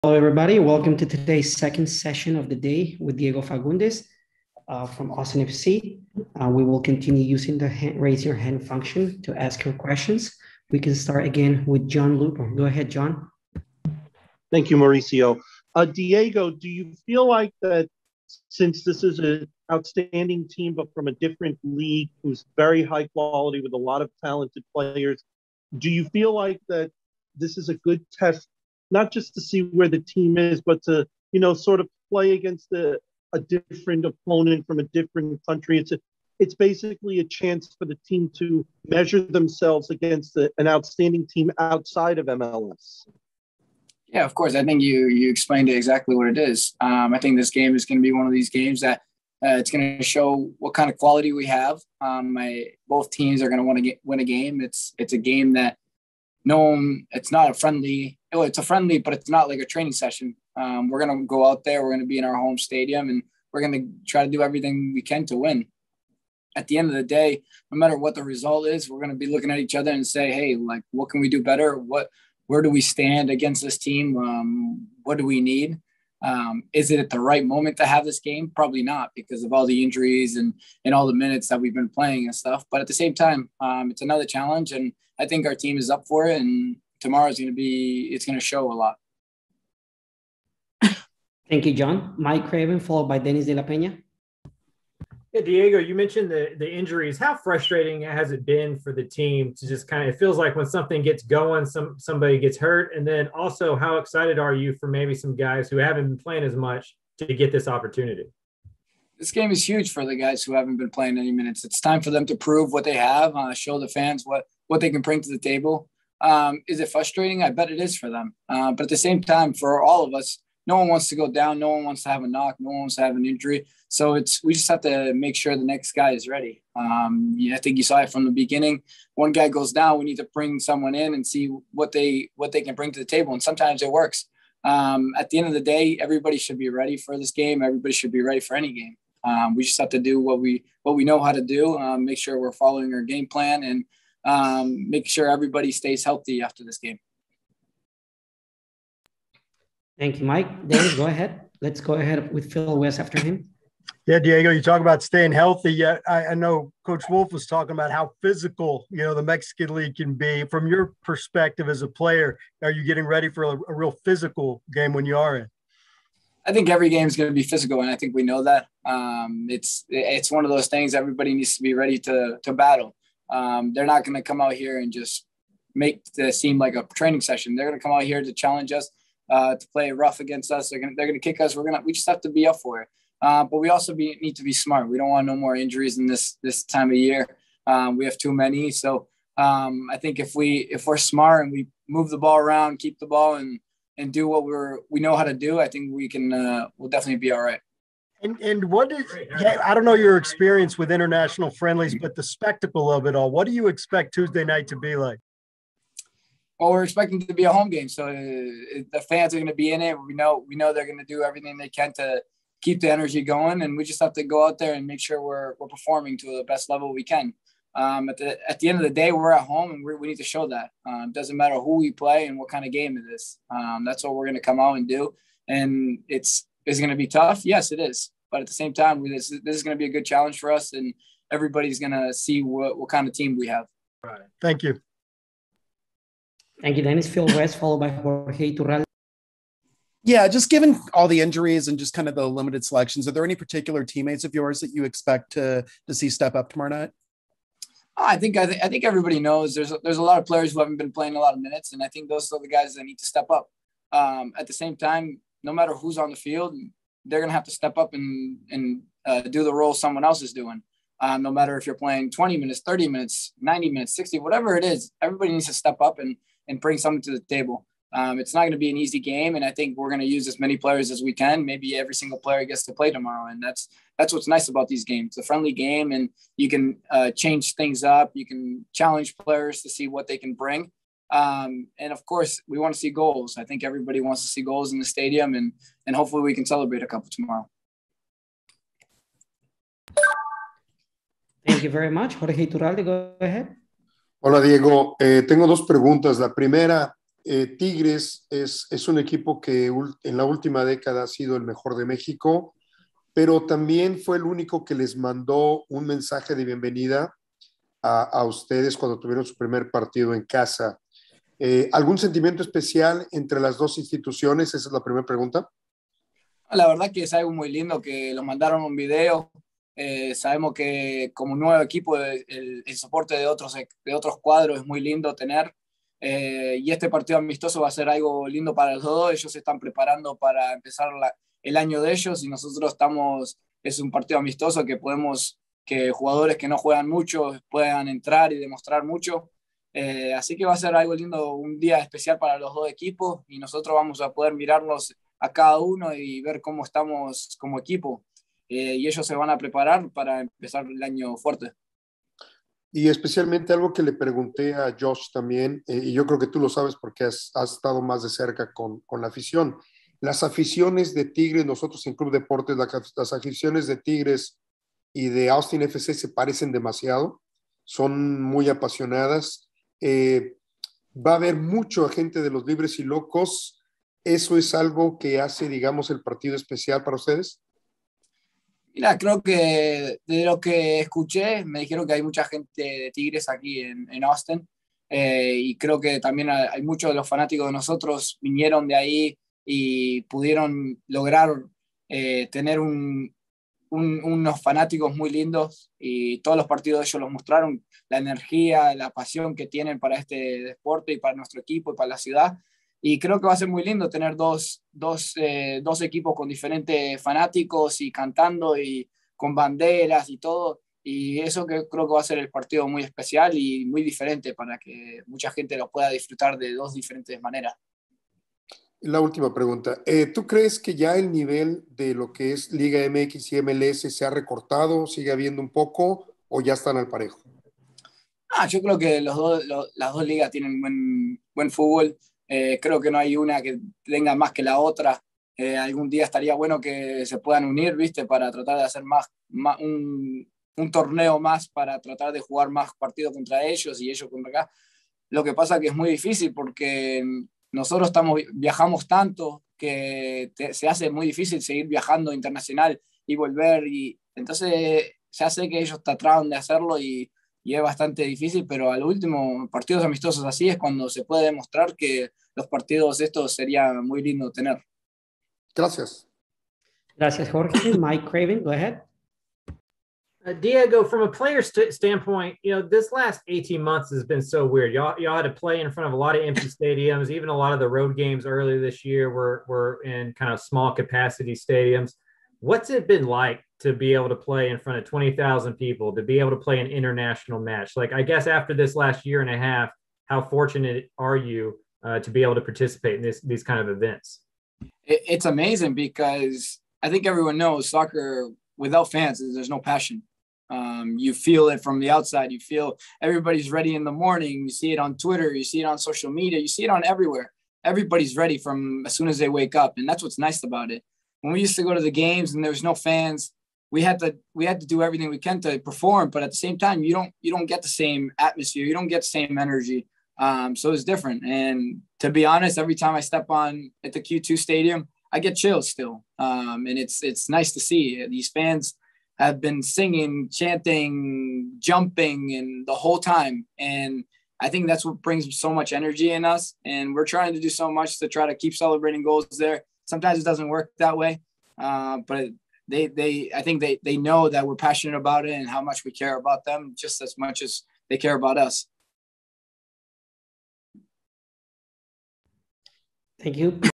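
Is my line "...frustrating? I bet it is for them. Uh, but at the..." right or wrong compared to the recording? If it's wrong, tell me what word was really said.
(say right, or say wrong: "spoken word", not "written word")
right.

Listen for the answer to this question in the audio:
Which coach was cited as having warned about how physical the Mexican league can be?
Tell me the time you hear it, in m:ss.
2:36.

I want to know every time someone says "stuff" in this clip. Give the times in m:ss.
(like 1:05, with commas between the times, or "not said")
1:22.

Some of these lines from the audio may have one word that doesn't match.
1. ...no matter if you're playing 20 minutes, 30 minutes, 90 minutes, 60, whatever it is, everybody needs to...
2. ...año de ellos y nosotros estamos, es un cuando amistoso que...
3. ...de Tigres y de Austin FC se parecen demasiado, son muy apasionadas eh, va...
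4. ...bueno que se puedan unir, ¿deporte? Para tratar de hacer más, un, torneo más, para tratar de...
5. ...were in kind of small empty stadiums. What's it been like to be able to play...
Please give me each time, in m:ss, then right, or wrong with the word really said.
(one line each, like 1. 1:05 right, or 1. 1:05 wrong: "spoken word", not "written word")
1. 4:21 right
2. 5:31 wrong: "partido", not "cuando"
3. 6:03 right
4. 7:16 wrong: "viste", not "deporte"
5. 7:59 wrong: "capacity", not "empty".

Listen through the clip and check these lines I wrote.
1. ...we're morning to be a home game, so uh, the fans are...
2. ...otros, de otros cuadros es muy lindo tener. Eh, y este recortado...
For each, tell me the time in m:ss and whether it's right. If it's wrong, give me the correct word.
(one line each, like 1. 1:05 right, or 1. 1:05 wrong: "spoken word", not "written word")
1. 3:26 wrong: "expecting", not "morning"
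2. 5:23 wrong: "partido", not "recortado".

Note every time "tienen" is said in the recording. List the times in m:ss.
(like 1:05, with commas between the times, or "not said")
6:39, 7:10.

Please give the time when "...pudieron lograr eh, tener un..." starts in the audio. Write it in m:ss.
6:30.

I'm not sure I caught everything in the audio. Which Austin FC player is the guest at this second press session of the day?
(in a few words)
Diego Fagundez.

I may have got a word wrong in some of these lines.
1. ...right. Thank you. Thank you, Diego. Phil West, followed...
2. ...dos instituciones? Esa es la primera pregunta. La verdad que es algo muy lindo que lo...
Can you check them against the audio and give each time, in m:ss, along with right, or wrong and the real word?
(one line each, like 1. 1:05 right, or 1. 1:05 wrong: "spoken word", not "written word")
1. 3:54 wrong: "Dennis", not "Diego"
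2. 5:13 right.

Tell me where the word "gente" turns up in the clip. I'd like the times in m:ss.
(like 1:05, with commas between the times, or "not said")
6:11, 6:22, 6:55.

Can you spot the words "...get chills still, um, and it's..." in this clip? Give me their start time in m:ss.
8:45.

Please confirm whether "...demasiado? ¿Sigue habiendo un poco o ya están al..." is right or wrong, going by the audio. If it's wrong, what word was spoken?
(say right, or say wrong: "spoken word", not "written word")
wrong: "recortado", not "demasiado".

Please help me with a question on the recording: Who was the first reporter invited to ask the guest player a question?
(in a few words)
John Lupo.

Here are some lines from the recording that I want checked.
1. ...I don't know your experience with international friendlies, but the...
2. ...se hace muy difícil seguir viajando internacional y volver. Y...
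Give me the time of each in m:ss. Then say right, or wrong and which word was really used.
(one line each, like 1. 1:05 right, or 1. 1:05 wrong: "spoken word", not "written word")
1. 3:19 right
2. 7:30 right.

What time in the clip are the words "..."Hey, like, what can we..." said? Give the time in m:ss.
1:10.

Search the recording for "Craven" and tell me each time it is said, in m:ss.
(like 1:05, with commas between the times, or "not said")
1:32, 7:48.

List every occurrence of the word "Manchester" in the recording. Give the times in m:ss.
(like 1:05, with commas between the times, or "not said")
not said.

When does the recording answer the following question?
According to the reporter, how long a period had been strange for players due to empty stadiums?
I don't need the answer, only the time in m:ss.
7:53.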